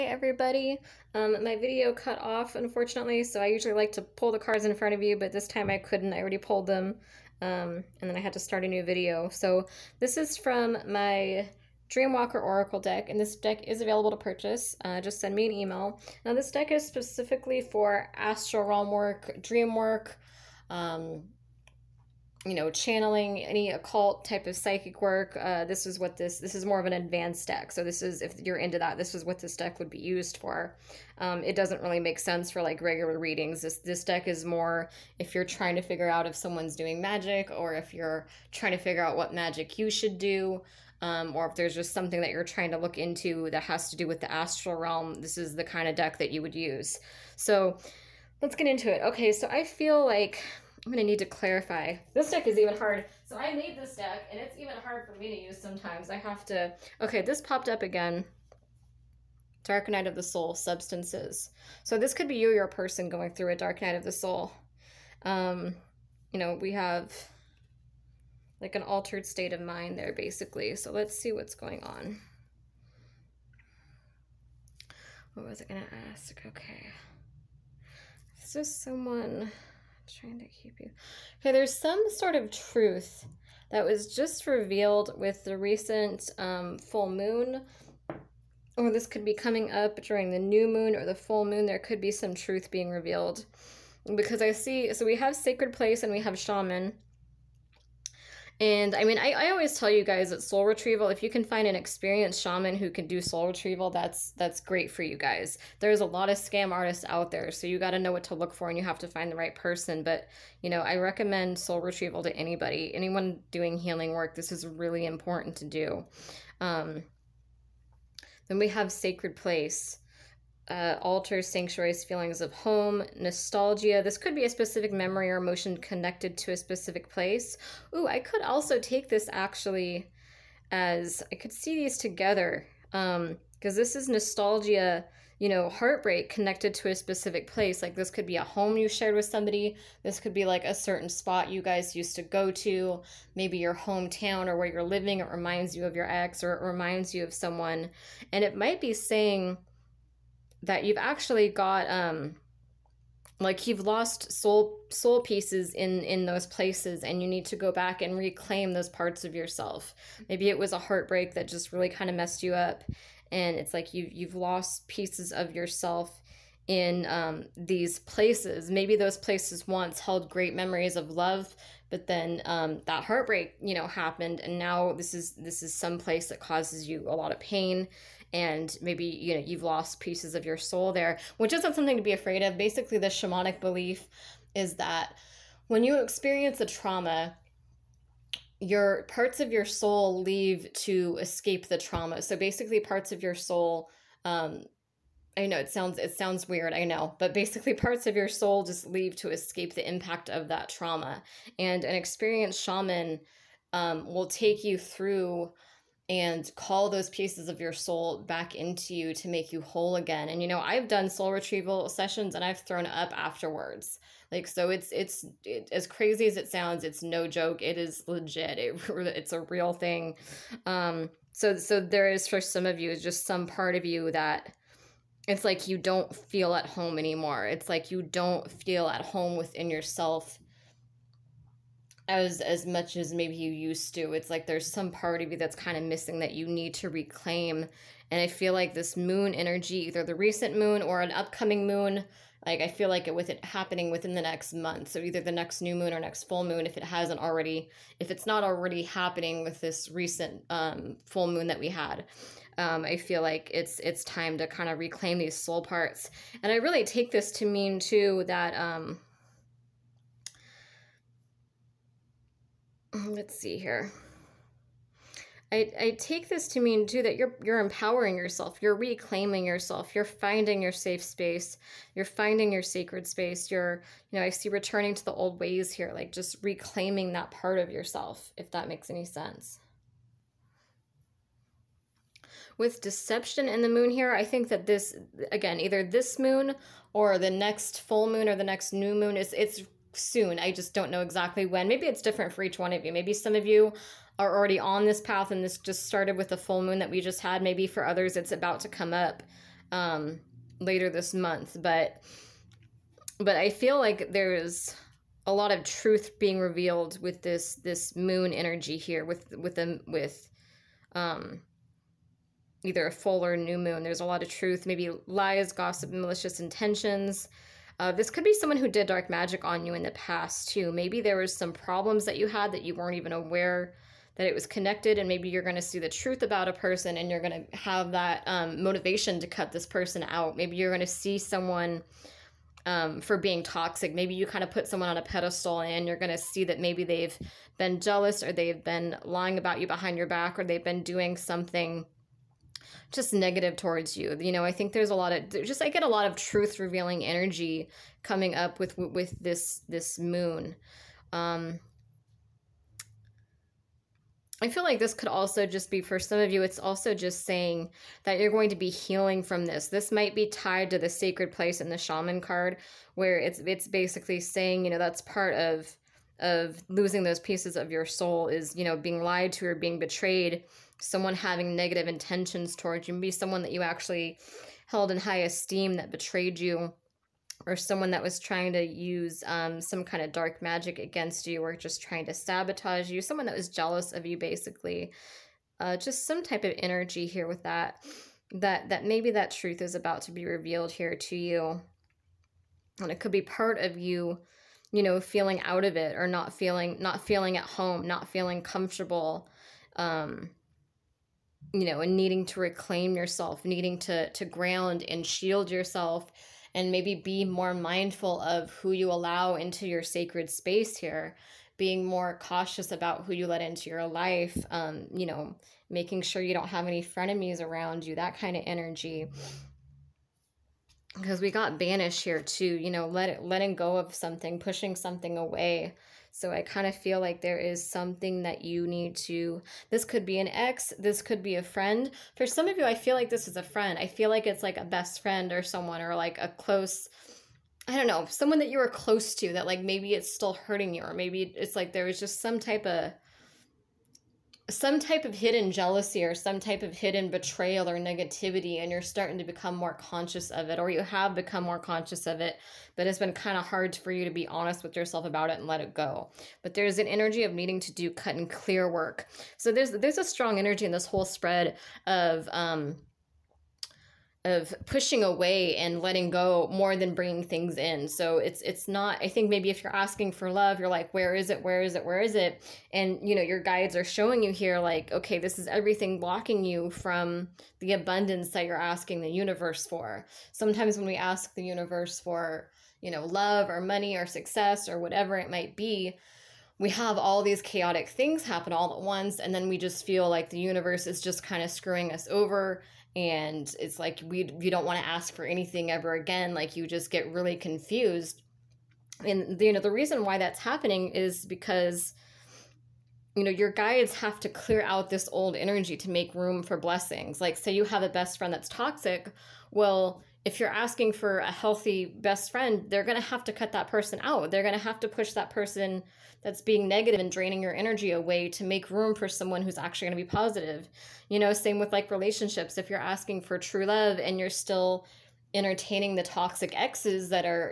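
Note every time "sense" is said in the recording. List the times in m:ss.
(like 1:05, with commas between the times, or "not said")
0:32, 4:39.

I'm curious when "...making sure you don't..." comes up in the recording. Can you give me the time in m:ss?
6:55.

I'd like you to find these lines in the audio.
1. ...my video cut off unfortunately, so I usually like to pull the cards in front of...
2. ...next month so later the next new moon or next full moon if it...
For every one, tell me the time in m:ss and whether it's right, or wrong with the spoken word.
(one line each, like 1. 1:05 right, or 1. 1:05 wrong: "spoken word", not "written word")
1. 0:01 right
2. 4:04 wrong: "either", not "later".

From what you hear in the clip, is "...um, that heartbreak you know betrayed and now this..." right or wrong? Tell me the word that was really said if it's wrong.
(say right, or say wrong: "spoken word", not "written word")
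wrong: "happened", not "betrayed".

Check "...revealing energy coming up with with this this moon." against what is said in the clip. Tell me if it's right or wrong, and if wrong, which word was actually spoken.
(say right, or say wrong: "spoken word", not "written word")
right.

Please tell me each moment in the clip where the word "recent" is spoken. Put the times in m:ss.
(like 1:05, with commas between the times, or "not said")
1:25, 4:00, 4:09.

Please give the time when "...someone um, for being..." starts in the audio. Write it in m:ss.
5:31.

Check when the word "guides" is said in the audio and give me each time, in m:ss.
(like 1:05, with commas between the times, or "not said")
7:53, 8:23.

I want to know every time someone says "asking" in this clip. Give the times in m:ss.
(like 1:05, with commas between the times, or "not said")
7:49, 7:58, 8:30, 8:42.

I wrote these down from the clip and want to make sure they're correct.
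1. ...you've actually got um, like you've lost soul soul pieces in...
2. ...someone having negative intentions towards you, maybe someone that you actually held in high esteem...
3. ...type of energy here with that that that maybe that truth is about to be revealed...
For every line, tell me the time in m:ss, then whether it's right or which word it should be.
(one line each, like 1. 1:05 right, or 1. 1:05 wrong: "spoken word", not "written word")
1. 2:30 right
2. 6:10 right
3. 6:26 right.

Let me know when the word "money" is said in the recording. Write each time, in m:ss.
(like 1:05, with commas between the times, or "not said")
8:03.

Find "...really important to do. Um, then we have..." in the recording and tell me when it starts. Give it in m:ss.
1:54.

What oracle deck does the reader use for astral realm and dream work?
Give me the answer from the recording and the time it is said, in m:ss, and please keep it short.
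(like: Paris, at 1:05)
Dreamwalker Oracle, at 0:11.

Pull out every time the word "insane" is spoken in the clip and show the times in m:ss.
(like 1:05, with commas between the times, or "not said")
not said.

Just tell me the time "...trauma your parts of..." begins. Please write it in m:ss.
3:06.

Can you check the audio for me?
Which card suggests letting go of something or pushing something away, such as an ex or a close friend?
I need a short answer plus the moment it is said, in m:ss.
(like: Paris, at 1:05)
Banished, at 7:01.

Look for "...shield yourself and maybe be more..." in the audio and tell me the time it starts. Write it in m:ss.
6:45.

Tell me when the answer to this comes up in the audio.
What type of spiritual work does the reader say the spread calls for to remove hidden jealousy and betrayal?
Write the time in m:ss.
7:37.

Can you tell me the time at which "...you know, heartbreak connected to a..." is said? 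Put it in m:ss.
2:15.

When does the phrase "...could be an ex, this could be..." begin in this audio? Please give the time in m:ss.
7:09.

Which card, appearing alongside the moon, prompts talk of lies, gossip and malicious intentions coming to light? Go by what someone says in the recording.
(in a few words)
Deception.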